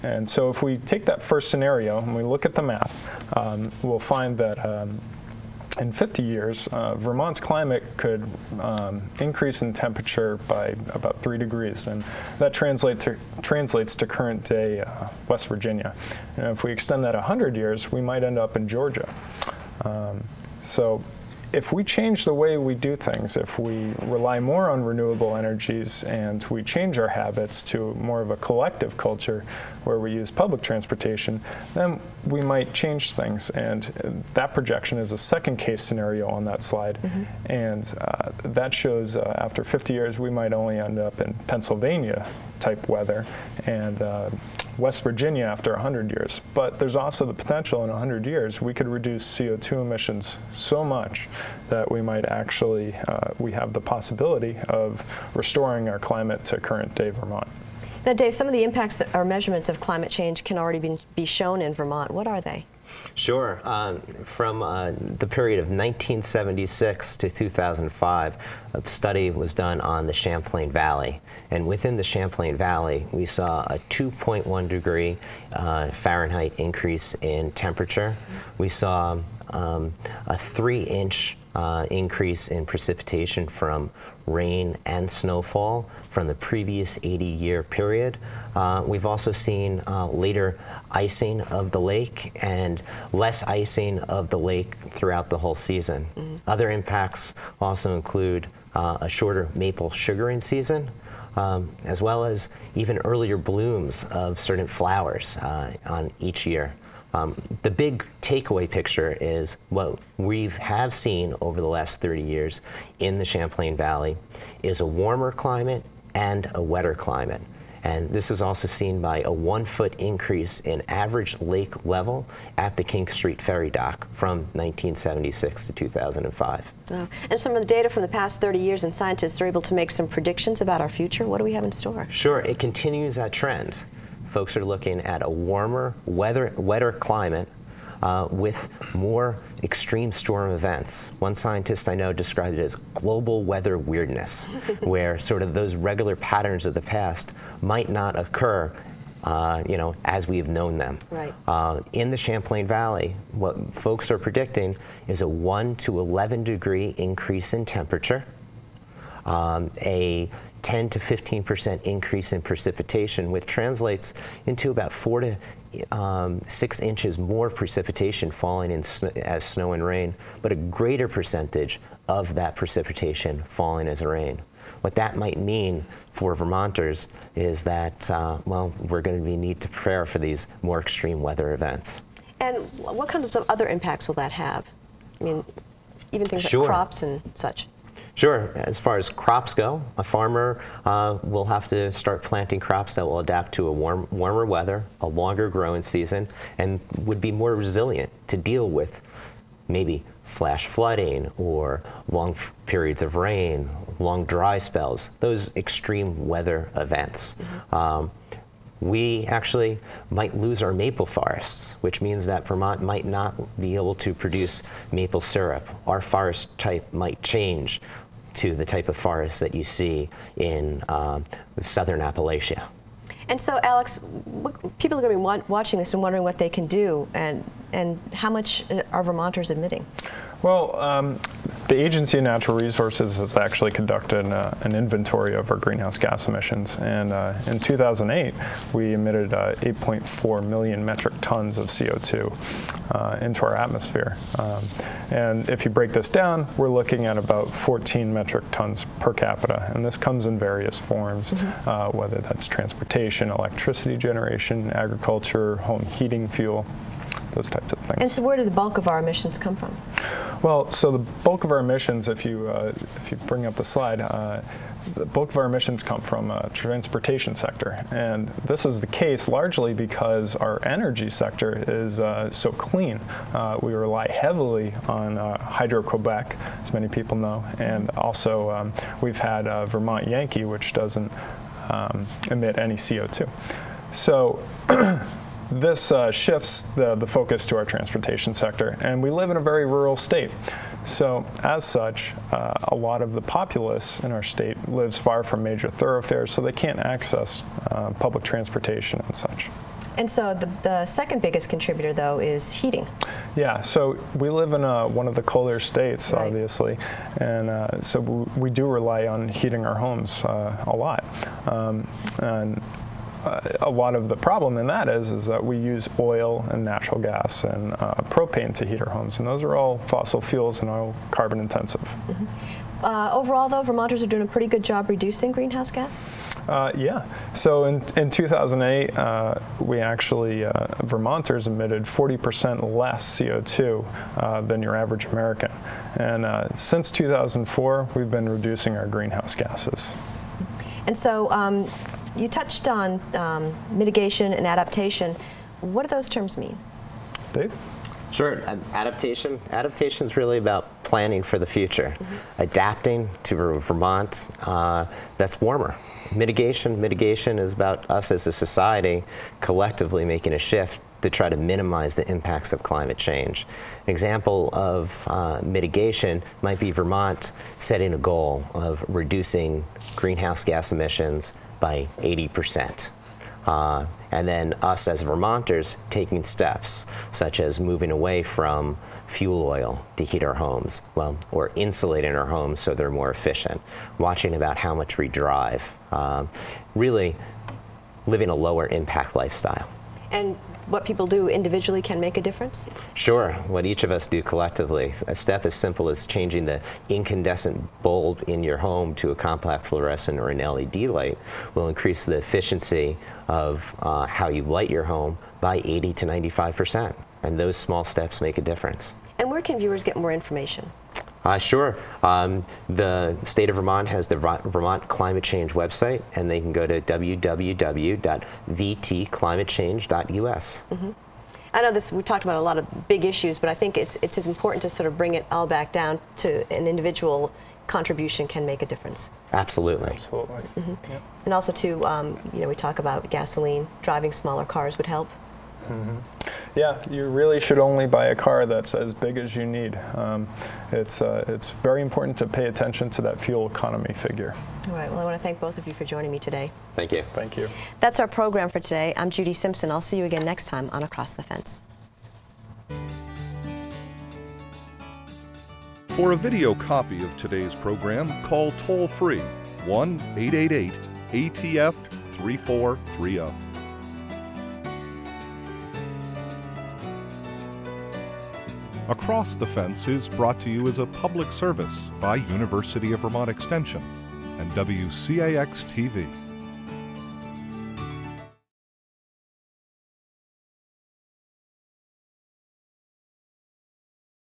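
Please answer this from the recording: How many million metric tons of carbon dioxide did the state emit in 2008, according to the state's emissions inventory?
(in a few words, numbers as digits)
8.4 million.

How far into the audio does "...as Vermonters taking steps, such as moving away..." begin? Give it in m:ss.
6:14.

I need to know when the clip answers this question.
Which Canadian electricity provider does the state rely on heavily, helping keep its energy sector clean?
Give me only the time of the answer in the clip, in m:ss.
4:35.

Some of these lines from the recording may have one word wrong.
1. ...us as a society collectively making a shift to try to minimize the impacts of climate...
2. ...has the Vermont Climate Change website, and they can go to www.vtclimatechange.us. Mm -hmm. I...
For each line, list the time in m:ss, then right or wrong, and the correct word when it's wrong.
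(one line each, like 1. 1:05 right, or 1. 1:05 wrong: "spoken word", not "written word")
1. 5:57 right
2. 6:53 right.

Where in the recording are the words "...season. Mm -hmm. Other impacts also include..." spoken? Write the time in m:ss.
1:35.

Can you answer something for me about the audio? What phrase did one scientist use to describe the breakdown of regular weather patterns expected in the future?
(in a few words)
global weather weirdness.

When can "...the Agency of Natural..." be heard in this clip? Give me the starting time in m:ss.
3:51.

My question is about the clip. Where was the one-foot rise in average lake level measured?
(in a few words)
King Street Ferry Dock.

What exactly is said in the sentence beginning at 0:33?
And that projection is a second case scenario on that slide.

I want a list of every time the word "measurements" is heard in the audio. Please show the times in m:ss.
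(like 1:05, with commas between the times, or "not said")
0:59.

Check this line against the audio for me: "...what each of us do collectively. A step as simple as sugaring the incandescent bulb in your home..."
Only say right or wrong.
wrong.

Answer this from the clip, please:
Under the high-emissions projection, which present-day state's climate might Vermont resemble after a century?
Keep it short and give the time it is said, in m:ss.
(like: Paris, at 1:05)
Georgia, at 0:18.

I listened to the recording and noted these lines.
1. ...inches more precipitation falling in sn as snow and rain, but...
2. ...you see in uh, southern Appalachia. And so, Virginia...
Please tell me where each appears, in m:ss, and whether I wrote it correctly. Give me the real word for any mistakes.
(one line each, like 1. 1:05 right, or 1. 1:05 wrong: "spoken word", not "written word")
1. 2:46 right
2. 3:39 wrong: "Alex", not "Virginia".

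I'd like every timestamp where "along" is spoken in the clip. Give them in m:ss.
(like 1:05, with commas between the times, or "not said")
not said.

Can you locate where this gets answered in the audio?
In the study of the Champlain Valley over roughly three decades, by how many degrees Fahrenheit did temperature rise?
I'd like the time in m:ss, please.
1:13.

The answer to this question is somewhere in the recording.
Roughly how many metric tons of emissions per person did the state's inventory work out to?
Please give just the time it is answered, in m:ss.
4:07.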